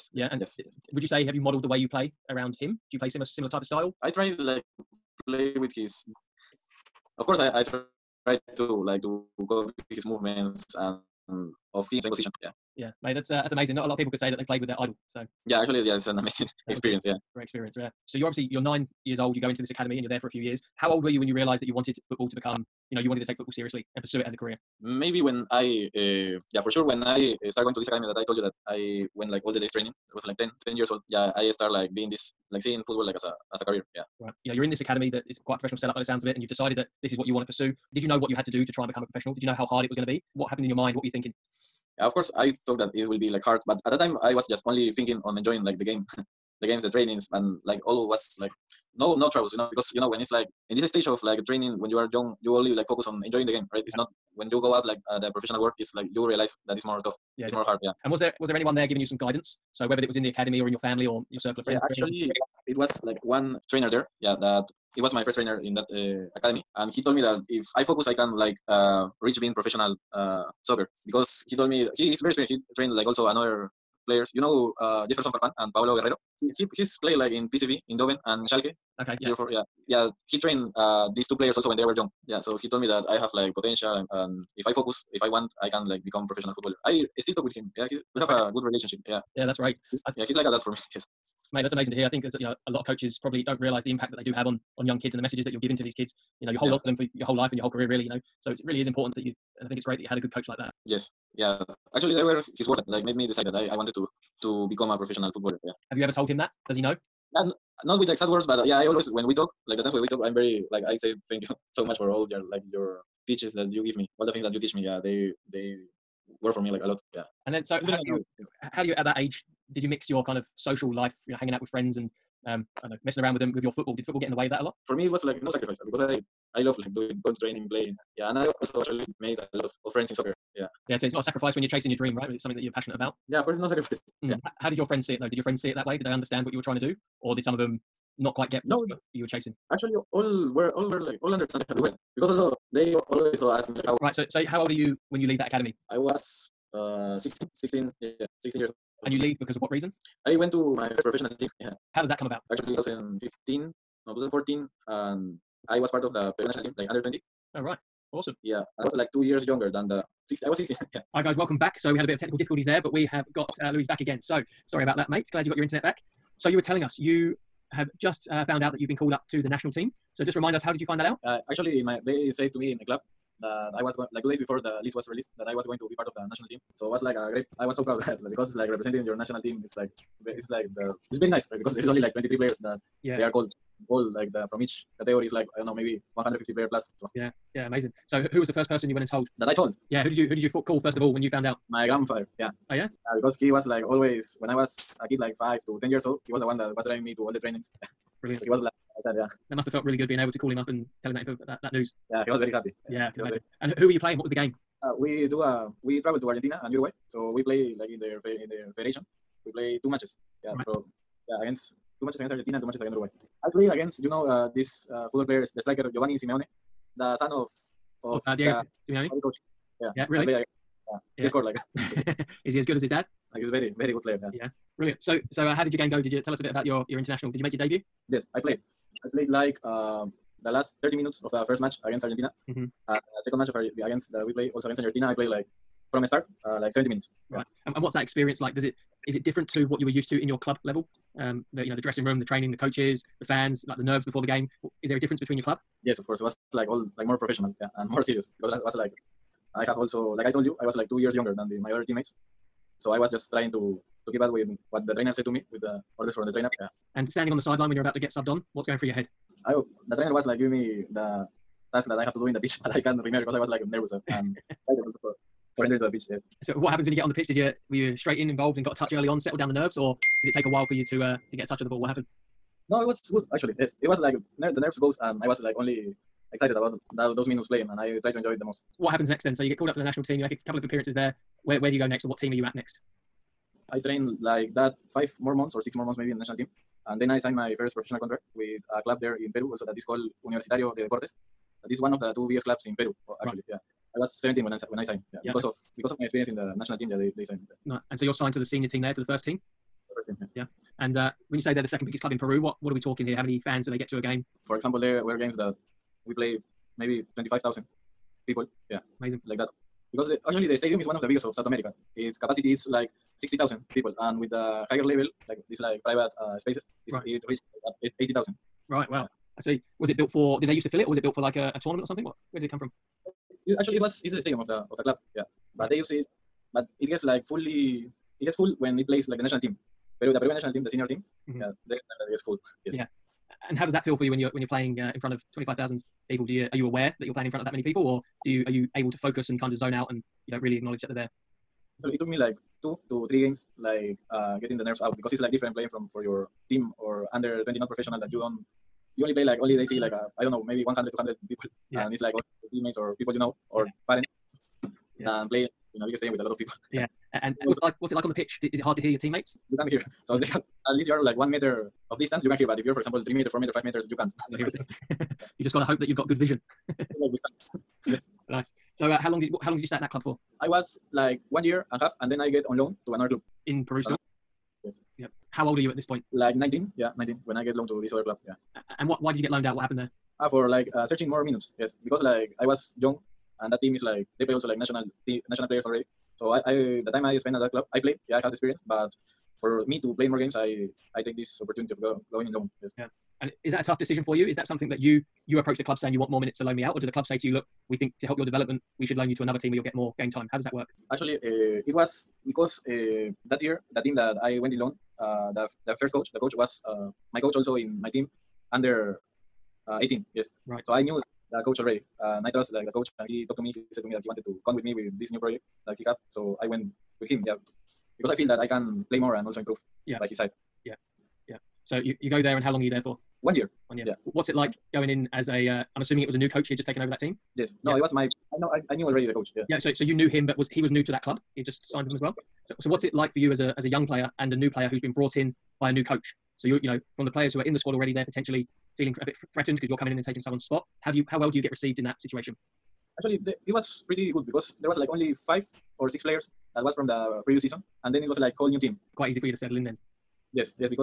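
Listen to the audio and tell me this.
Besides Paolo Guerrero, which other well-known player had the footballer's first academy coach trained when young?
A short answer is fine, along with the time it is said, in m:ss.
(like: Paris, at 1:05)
Jefferson Farfan, at 1:15.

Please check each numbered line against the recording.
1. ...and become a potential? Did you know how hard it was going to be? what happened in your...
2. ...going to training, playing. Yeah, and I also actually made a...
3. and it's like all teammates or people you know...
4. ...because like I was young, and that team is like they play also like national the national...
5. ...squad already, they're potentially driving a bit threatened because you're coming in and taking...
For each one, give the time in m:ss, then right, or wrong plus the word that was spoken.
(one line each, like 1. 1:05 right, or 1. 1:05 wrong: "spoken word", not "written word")
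1. 0:38 wrong: "professional", not "potential"
2. 2:07 right
3. 5:51 right
4. 6:21 right
5. 7:17 wrong: "feeling", not "driving".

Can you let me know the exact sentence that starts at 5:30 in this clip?
Peru, the Peruvian national team, the senior team.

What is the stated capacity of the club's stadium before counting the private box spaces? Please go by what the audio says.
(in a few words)
60,000.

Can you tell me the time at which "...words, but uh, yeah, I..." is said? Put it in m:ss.
1:48.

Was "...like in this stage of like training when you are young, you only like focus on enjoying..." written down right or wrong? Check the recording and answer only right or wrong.
right.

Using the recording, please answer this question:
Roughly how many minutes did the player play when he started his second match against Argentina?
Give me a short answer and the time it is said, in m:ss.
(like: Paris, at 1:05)
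70 minutes, at 3:56.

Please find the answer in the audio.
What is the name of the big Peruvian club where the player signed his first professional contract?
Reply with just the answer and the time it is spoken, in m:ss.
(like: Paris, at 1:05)
Universitario de Deportes, at 4:50.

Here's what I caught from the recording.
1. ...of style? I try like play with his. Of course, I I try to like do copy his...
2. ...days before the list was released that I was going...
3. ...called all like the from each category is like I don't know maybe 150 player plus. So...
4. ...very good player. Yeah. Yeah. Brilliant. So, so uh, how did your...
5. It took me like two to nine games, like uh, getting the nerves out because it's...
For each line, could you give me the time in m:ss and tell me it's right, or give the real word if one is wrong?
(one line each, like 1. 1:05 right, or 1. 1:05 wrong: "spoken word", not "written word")
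1. 0:03 right
2. 2:54 right
3. 3:03 right
4. 3:43 right
5. 5:41 wrong: "three", not "nine".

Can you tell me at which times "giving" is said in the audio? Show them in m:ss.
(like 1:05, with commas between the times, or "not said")
0:58, 1:35, 4:20.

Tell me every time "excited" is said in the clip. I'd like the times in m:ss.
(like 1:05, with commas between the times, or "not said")
4:24, 4:36.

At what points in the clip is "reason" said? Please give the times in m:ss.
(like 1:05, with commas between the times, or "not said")
2:29.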